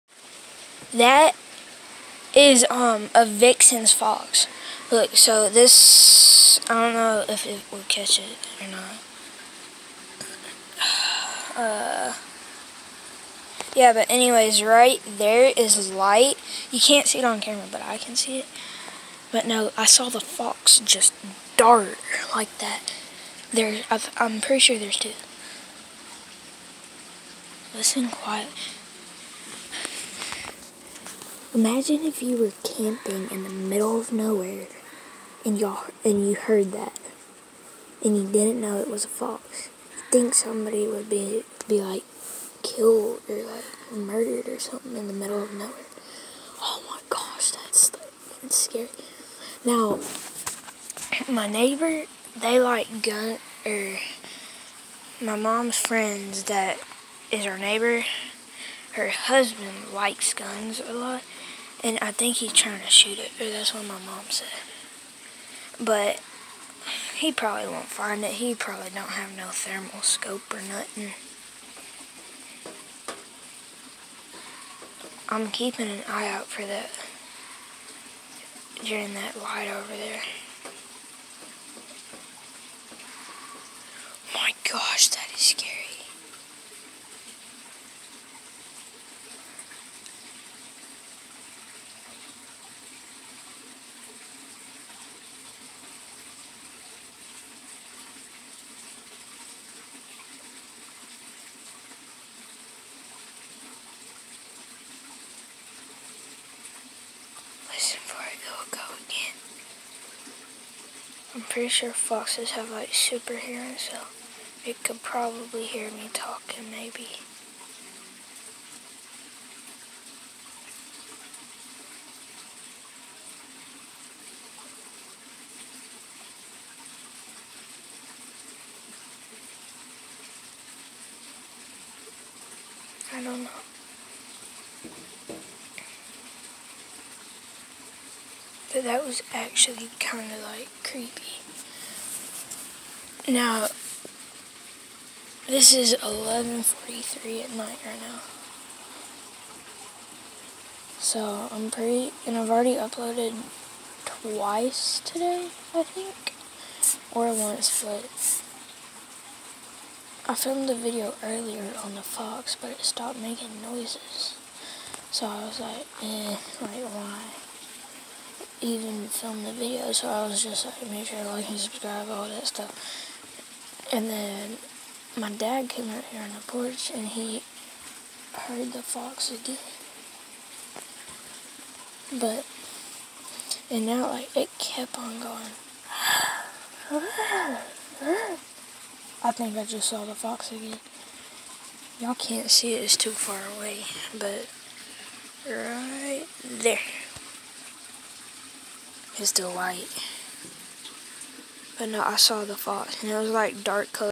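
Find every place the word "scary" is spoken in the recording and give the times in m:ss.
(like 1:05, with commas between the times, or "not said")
0:48, 1:25.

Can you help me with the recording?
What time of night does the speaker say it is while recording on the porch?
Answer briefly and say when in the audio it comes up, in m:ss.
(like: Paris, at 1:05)
11:43, at 2:26.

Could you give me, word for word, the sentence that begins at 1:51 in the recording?
I'm pretty sure foxes have like super hearing, so it could probably hear me talking maybe.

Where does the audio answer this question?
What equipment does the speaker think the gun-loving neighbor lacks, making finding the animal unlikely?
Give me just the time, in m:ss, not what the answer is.
1:09.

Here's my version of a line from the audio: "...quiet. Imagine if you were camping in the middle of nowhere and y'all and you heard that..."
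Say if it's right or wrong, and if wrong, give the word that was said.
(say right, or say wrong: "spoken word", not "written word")
right.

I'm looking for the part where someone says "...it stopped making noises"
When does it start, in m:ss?
2:42.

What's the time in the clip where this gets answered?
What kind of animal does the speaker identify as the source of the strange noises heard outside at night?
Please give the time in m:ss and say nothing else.
0:03.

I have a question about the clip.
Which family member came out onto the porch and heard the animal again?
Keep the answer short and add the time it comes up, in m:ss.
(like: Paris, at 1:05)
dad, at 2:55.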